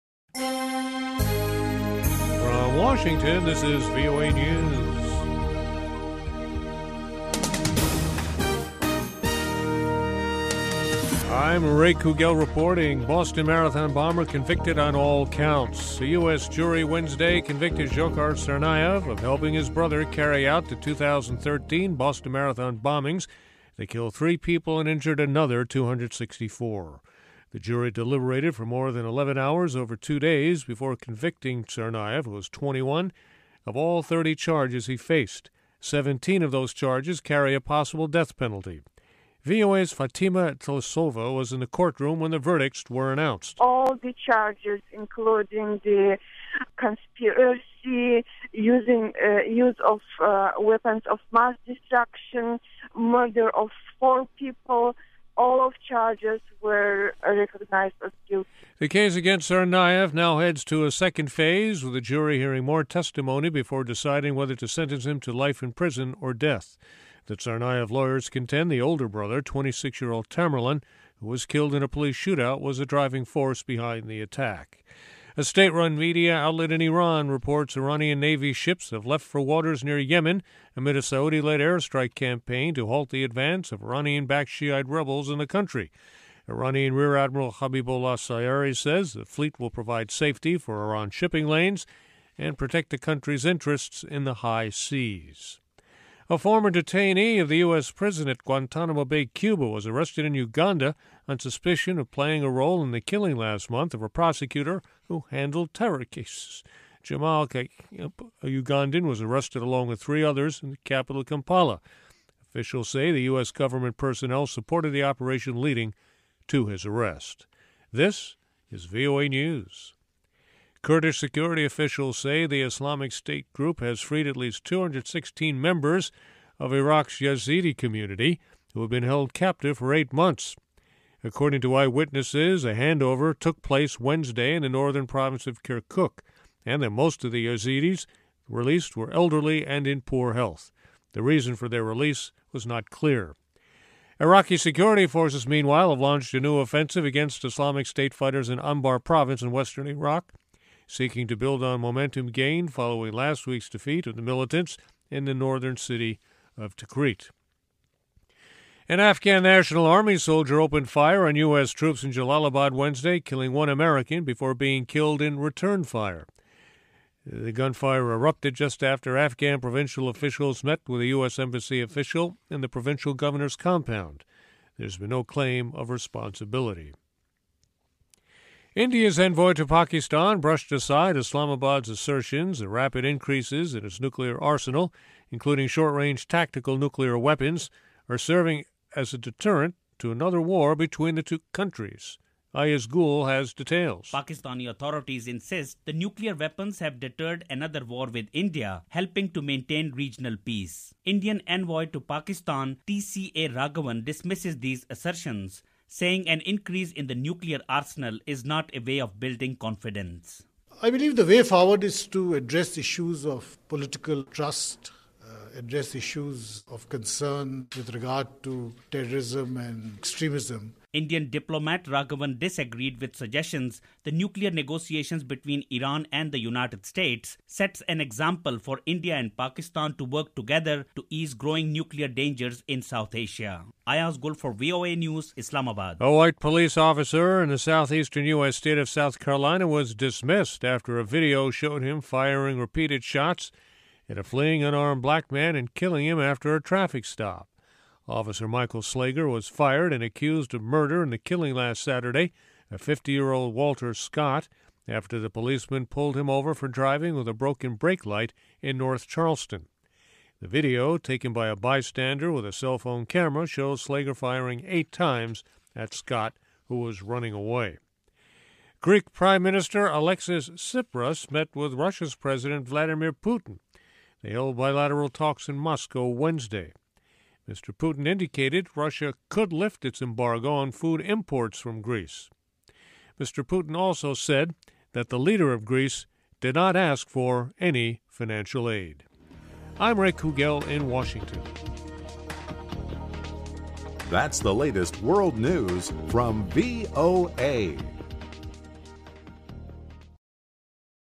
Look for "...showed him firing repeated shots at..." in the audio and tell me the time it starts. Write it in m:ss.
4:01.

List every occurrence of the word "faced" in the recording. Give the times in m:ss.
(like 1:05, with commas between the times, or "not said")
0:34.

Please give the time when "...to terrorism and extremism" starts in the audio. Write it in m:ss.
3:38.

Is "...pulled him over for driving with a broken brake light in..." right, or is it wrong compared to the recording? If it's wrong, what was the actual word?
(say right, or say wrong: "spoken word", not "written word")
right.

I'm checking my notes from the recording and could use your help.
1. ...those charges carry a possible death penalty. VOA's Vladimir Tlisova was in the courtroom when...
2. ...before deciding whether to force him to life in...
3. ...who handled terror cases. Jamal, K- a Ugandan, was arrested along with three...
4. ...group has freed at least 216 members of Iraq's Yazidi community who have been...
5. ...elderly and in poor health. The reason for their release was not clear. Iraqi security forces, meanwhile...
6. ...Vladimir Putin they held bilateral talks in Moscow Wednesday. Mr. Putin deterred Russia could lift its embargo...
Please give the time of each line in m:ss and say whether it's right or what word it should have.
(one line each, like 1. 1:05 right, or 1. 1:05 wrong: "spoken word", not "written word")
1. 0:36 wrong: "Fatima", not "Vladimir"
2. 1:03 wrong: "sentence", not "force"
3. 1:45 right
4. 2:03 right
5. 2:19 right
6. 4:32 wrong: "indicated", not "deterred".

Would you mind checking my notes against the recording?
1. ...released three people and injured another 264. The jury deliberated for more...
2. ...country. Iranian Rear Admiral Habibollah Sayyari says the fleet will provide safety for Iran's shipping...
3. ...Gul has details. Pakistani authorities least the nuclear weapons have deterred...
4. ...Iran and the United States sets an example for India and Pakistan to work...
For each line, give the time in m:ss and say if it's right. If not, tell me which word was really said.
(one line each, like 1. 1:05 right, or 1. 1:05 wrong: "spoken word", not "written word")
1. 0:23 wrong: "killed", not "released"
2. 1:25 right
3. 3:12 wrong: "insist", not "least"
4. 3:45 right.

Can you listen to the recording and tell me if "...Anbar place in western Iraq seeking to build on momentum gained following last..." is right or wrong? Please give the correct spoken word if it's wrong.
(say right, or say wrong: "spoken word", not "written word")
wrong: "province", not "place".